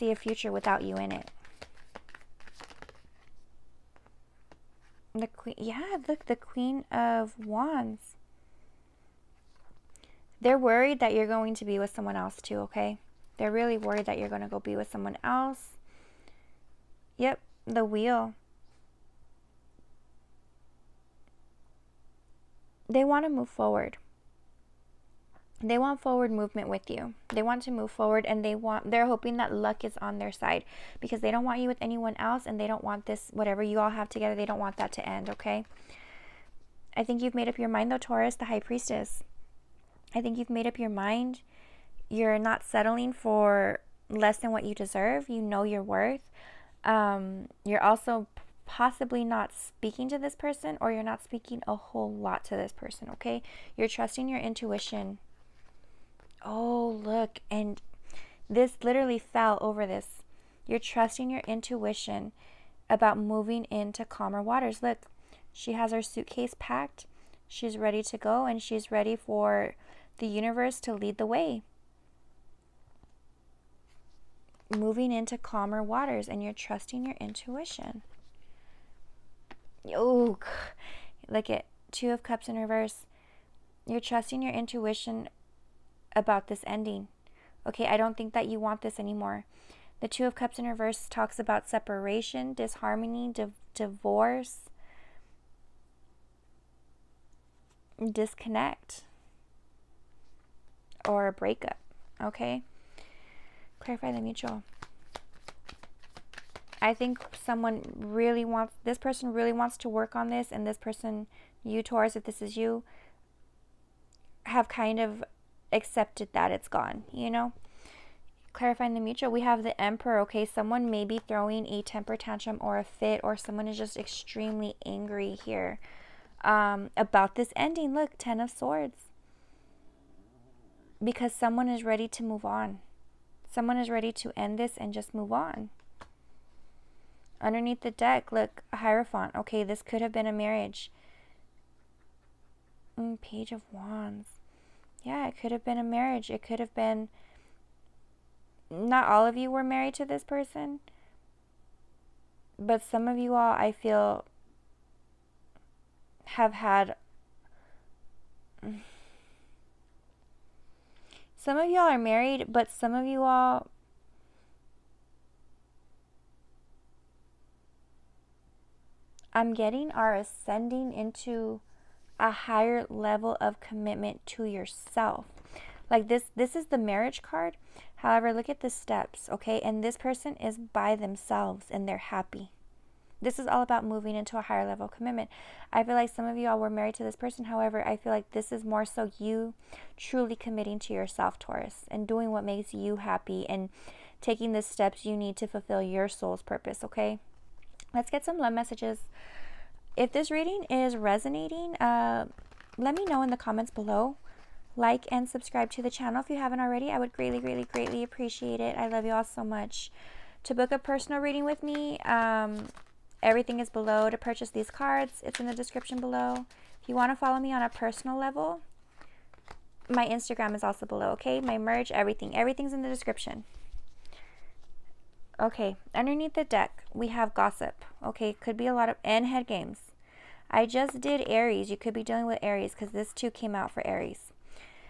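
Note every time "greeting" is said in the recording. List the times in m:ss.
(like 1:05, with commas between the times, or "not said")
not said.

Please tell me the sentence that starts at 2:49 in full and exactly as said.
I'm getting are ascending into a higher level of commitment to yourself.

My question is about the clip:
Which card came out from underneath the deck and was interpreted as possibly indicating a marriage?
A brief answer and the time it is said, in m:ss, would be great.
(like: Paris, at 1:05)
Hierophant, at 2:18.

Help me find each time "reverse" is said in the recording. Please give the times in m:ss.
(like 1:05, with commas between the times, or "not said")
1:22, 1:30.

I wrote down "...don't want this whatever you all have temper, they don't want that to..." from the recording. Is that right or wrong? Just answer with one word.
wrong.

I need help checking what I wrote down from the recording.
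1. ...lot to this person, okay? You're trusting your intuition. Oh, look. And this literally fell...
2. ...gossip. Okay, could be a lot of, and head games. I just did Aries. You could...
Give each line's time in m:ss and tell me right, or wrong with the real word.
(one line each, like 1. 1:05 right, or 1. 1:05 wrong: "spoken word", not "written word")
1. 0:52 right
2. 3:47 right.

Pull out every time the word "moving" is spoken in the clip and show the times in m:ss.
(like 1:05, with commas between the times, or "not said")
1:03, 1:14, 3:03.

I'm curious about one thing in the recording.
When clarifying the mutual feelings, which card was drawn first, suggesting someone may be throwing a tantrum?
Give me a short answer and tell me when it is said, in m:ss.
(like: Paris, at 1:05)
The Emperor, at 1:59.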